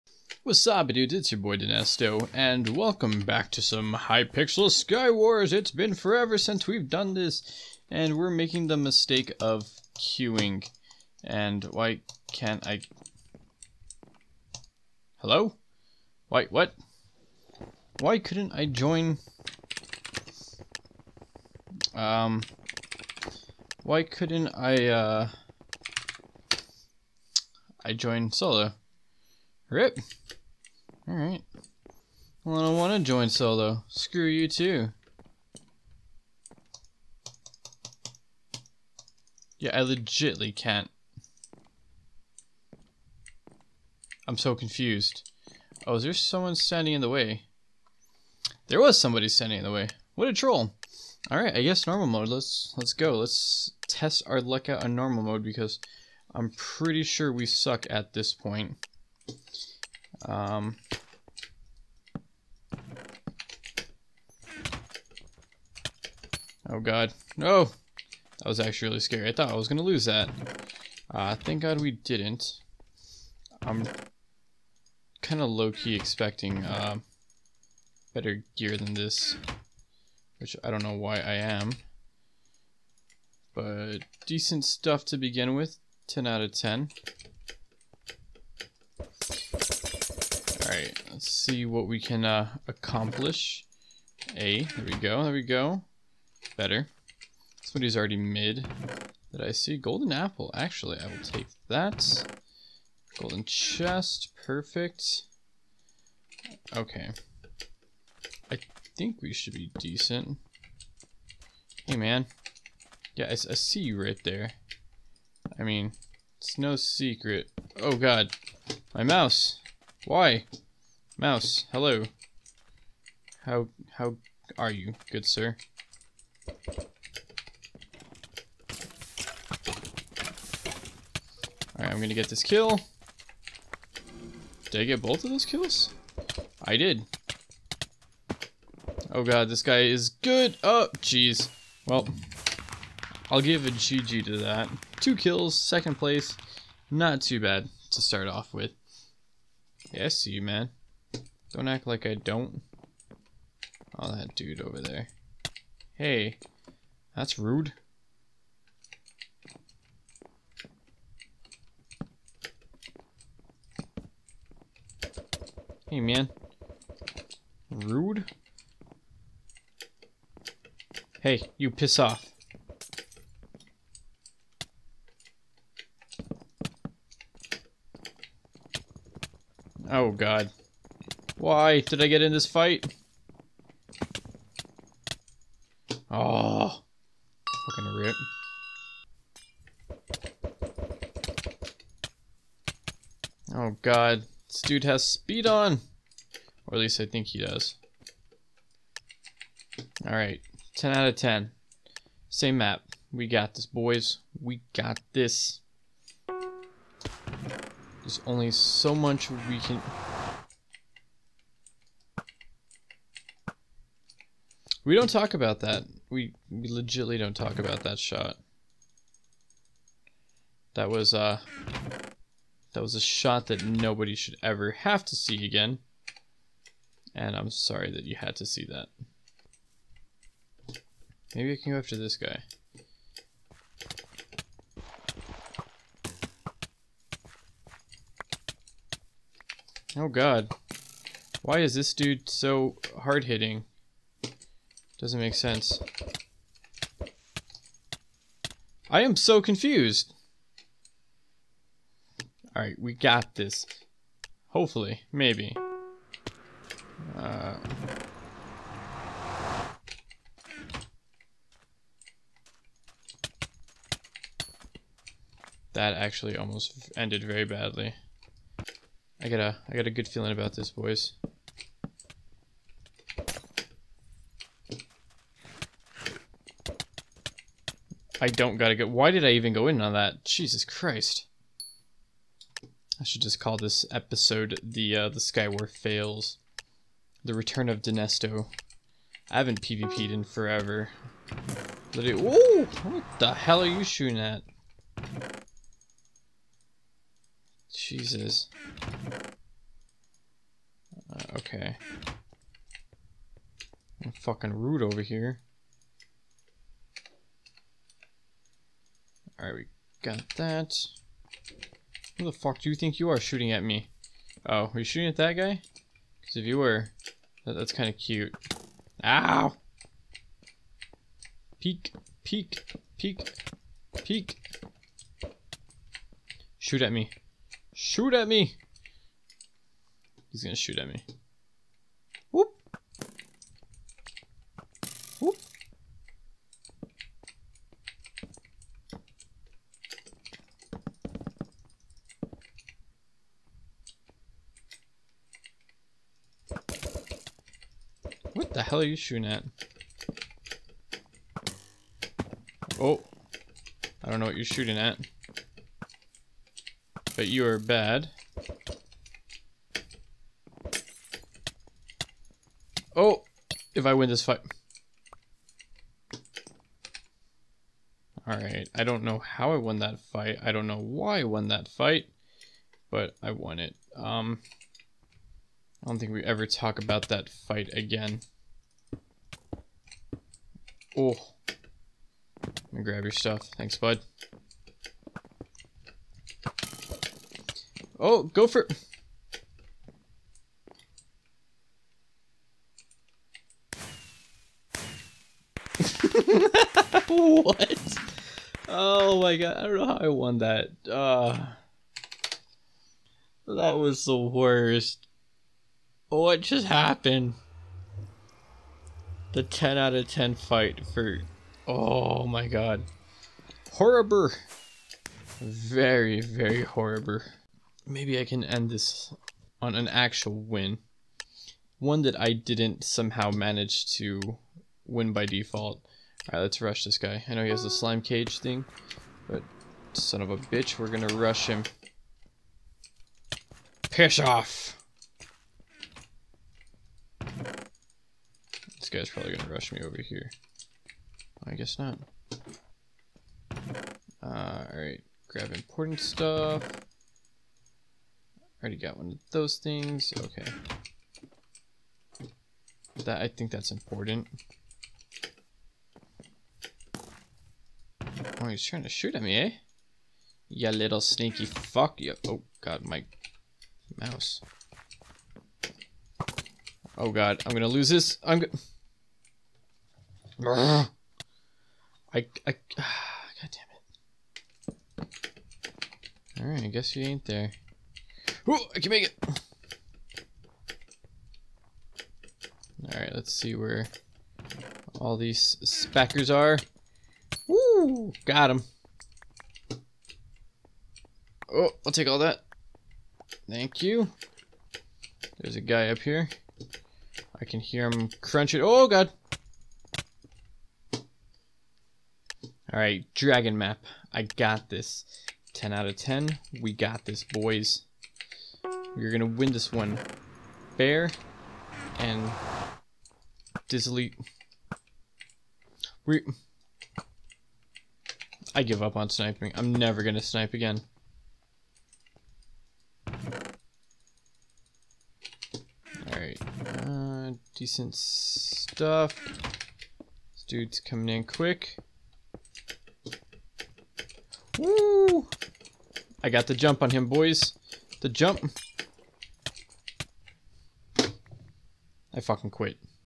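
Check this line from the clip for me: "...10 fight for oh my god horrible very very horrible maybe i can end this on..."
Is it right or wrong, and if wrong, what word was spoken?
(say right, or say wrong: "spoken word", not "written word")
right.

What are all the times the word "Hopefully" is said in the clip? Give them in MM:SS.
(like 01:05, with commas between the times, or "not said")
04:14.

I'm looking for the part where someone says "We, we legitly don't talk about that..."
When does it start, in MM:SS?
03:36.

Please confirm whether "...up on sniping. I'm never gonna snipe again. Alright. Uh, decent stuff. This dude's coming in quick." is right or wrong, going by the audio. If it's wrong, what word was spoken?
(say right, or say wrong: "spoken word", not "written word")
right.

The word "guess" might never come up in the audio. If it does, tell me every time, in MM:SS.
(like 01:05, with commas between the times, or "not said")
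00:51, 07:21, 07:56.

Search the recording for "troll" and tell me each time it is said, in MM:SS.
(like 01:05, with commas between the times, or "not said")
00:50.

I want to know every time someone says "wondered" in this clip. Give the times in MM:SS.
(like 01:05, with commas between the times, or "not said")
not said.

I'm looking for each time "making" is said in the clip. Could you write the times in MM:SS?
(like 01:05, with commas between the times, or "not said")
00:08.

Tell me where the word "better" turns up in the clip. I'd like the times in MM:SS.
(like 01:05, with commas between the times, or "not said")
01:18, 01:36.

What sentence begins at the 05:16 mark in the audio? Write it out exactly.
Because if you were, that, that's kind of cute.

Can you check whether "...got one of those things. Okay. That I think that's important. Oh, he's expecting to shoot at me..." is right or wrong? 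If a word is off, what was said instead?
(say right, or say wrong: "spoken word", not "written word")
wrong: "trying", not "expecting".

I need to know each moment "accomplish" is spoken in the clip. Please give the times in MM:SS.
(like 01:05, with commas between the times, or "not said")
01:32.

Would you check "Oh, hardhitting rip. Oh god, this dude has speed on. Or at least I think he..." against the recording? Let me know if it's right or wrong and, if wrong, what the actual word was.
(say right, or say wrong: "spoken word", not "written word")
wrong: "fucking", not "hardhitting".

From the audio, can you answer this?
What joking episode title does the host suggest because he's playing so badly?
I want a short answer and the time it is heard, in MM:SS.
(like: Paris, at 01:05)
the Skywar fails, at 04:45.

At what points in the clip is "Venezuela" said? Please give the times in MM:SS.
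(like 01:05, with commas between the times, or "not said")
not said.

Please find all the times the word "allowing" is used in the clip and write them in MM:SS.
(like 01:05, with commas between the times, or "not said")
not said.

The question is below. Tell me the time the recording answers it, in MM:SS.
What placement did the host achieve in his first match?
02:25.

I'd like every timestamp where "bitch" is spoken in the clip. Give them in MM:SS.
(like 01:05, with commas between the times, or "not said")
07:10.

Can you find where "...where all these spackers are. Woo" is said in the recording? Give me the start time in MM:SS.
08:03.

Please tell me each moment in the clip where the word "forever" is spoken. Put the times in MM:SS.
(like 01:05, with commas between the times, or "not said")
00:05, 04:50.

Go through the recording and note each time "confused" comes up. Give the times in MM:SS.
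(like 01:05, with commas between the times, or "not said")
00:44, 04:09.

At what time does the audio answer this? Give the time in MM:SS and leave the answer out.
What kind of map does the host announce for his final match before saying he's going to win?
08:23.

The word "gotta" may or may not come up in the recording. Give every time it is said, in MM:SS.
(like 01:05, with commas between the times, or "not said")
04:38.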